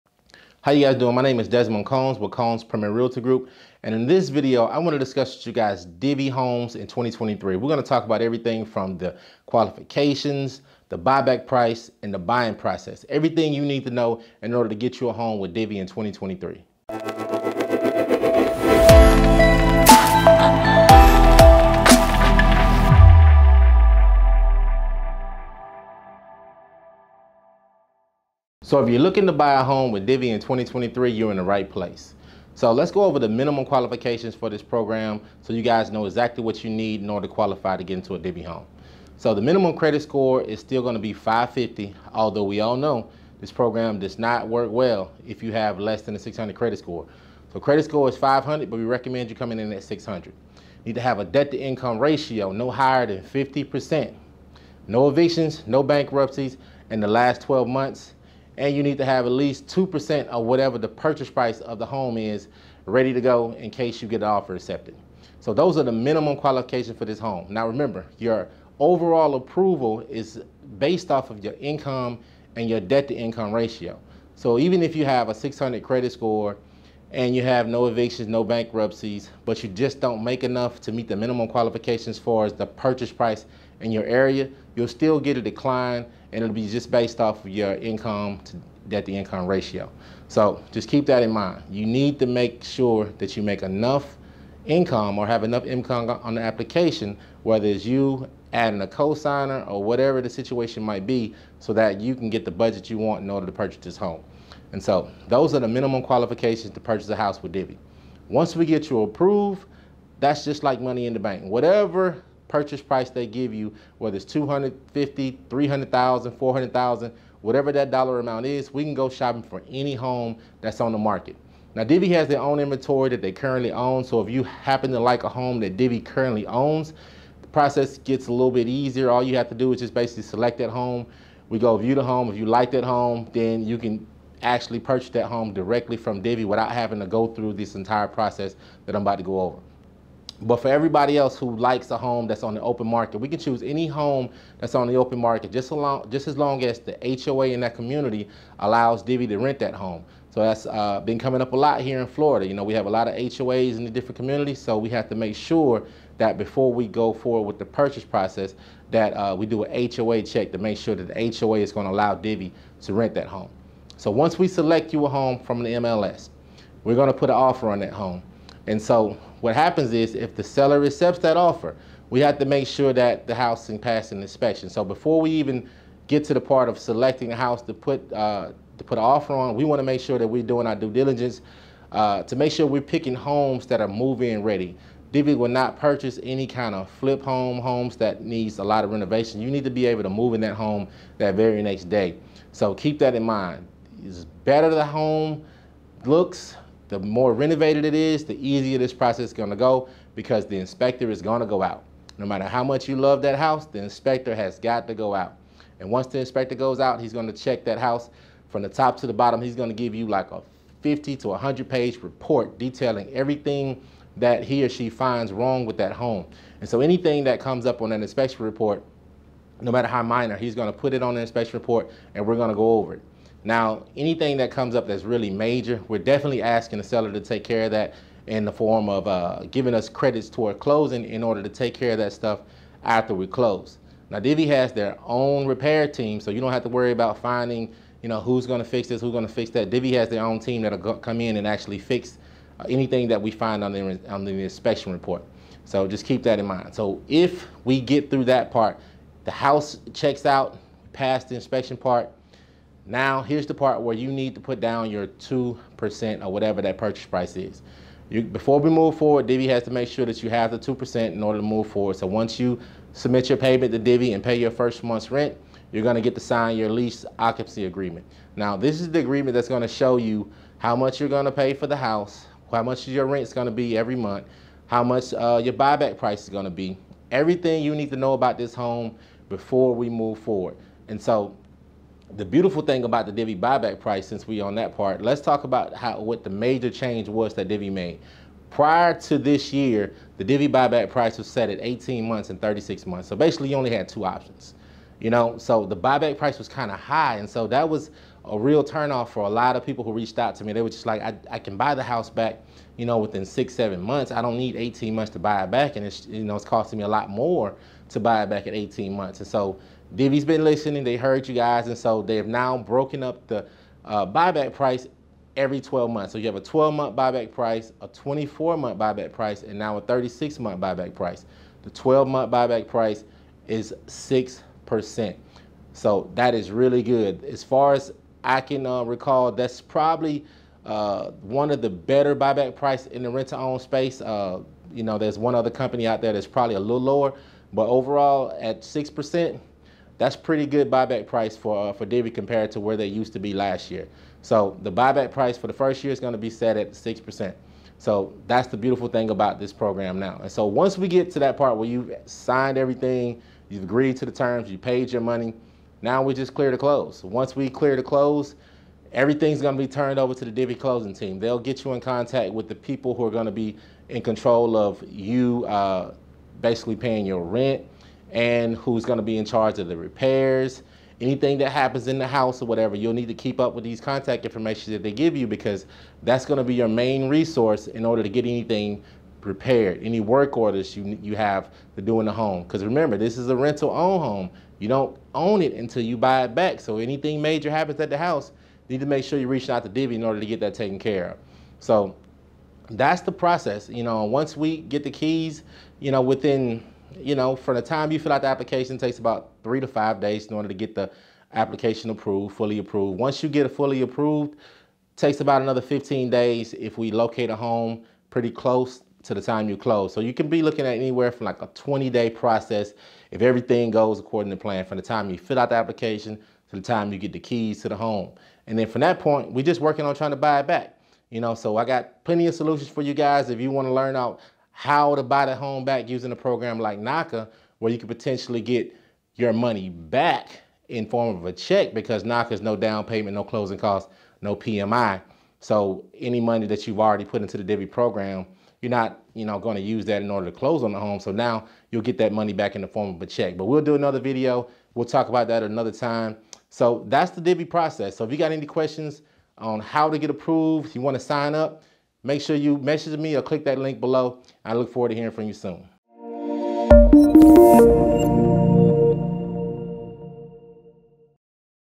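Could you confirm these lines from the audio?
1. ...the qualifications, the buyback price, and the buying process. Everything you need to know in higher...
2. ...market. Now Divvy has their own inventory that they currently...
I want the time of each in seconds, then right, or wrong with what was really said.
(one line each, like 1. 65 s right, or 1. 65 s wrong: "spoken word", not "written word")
1. 8 s wrong: "order", not "higher"
2. 120 s right.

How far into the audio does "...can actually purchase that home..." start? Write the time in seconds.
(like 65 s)
133 s.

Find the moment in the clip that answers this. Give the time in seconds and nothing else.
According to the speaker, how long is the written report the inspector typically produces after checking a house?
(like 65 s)
210 s.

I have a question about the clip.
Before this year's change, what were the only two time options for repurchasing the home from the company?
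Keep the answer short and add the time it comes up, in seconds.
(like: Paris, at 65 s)
18 and 36 months, at 291 s.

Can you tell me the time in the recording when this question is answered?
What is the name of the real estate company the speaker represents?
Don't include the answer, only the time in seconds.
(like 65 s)
2 s.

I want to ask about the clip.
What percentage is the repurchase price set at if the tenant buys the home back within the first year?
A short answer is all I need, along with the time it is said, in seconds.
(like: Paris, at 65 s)
6%, at 323 s.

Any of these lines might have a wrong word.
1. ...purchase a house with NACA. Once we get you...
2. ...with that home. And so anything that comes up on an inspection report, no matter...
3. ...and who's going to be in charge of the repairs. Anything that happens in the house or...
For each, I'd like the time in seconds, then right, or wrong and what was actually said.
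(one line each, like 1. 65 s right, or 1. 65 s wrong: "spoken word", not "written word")
1. 106 s wrong: "Divvy", not "NACA"
2. 215 s right
3. 368 s right.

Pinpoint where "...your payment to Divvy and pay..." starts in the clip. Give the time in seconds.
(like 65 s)
263 s.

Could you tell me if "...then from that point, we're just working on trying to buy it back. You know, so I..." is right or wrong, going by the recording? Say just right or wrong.
right.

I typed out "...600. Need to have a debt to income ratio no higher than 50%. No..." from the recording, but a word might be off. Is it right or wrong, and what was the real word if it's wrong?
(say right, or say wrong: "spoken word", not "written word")
right.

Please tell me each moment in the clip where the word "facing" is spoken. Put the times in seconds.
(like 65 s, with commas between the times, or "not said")
not said.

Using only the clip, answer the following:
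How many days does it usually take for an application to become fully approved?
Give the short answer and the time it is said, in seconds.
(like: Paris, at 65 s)
3 to 5 days, at 399 s.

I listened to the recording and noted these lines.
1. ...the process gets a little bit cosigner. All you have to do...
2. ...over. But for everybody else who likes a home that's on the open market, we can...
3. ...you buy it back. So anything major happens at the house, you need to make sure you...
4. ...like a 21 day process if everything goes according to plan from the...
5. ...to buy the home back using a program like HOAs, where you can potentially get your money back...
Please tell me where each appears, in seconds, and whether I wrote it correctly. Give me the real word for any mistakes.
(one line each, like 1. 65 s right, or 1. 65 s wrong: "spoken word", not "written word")
1. 127 s wrong: "easier", not "cosigner"
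2. 139 s right
3. 385 s right
4. 411 s wrong: "20", not "21"
5. 424 s wrong: "NACA", not "HOAs".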